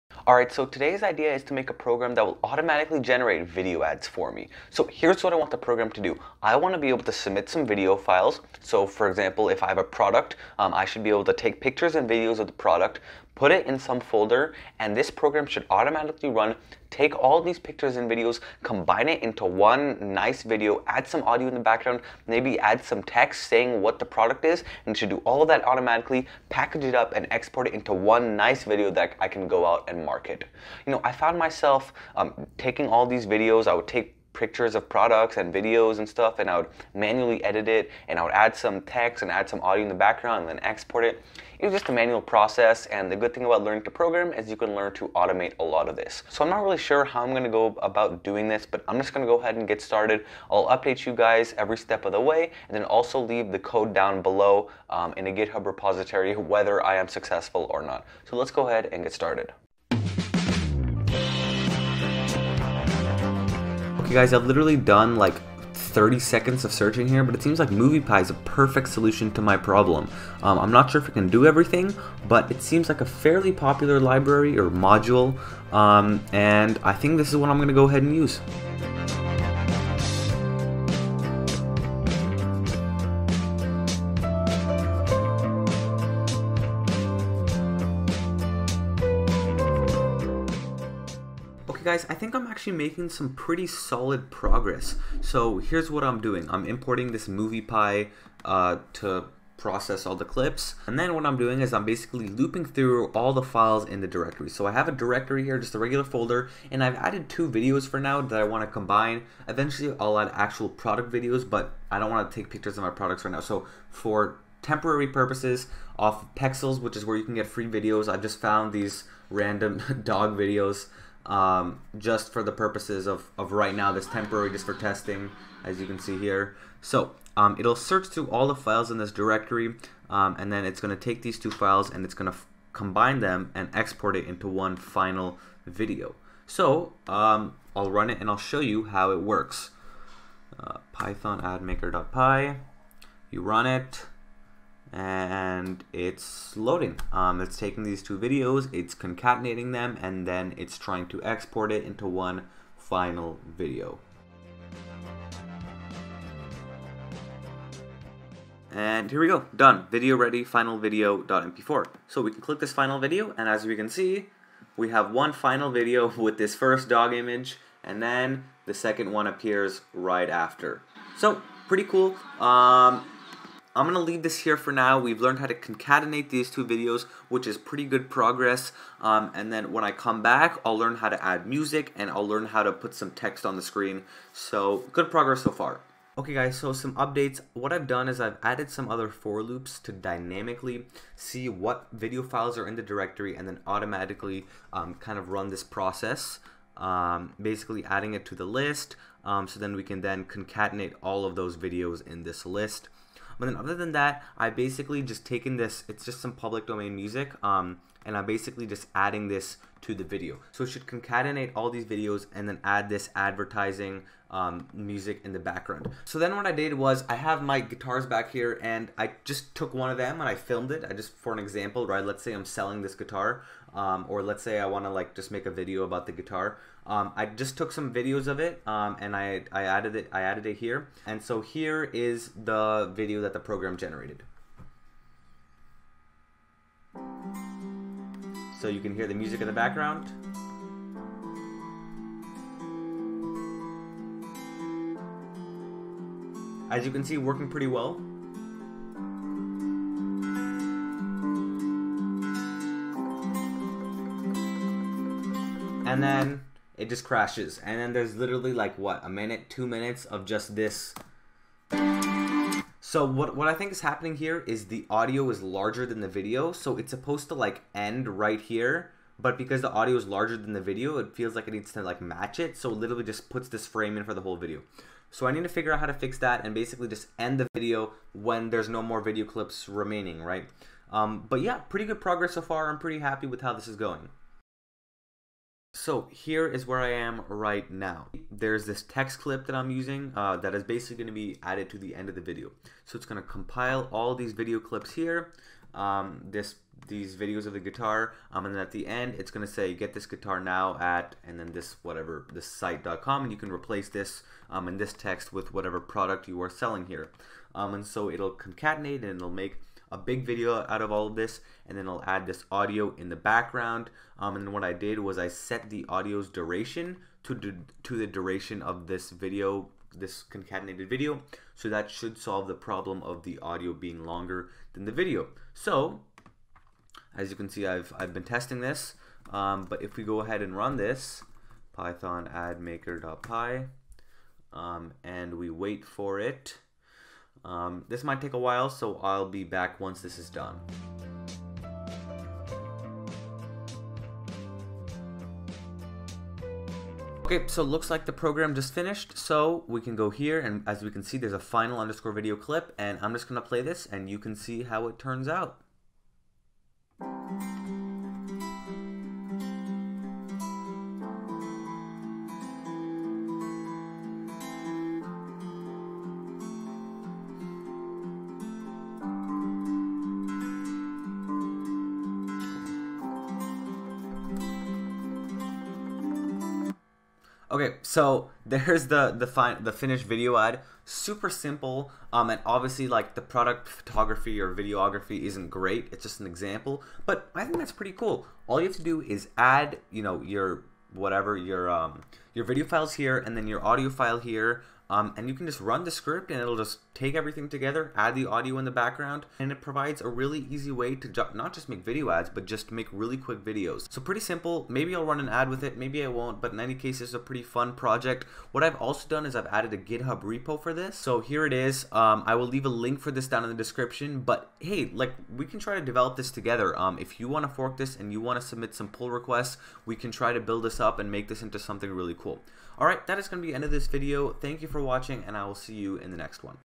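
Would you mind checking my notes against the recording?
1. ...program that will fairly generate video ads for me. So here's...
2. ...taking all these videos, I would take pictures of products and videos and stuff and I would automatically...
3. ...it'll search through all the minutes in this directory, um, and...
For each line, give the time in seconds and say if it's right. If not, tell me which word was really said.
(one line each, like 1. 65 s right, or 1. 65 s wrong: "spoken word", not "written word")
1. 1 s wrong: "automatically", not "fairly"
2. 32 s wrong: "manually", not "automatically"
3. 127 s wrong: "files", not "minutes".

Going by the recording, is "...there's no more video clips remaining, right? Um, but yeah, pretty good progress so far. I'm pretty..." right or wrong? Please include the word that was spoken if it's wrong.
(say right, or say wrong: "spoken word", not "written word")
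right.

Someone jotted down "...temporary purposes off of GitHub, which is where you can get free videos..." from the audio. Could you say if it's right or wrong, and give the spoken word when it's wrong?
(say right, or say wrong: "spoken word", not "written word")
wrong: "Pexels", not "GitHub".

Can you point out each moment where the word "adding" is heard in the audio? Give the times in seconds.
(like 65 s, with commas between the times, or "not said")
197 s, 208 s.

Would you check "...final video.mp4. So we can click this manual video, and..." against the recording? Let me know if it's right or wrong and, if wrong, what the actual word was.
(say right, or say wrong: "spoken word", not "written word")
wrong: "final", not "manual".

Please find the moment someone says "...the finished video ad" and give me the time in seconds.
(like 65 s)
379 s.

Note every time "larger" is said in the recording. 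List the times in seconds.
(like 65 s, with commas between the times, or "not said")
265 s, 270 s.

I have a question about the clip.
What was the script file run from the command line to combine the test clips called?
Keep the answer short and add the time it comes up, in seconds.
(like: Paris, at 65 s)
admaker.py, at 141 s.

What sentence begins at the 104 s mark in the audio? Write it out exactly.
So I have a directory here, just a regular folder, and I've added two videos for now that I want to combine.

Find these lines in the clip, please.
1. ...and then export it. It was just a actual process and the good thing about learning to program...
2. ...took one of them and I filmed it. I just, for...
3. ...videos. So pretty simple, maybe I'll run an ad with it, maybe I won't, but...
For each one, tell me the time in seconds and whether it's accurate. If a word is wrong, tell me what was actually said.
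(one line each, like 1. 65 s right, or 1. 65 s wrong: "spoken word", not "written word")
1. 40 s wrong: "manual", not "actual"
2. 219 s right
3. 403 s right.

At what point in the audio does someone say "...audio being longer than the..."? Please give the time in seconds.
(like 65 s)
323 s.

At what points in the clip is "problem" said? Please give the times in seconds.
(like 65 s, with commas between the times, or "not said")
69 s, 322 s.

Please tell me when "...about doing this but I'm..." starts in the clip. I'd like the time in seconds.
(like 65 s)
47 s.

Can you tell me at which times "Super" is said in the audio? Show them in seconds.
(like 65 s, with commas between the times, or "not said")
380 s.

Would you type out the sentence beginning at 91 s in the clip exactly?
Okay guys, I think I'm actually making some pretty solid progress.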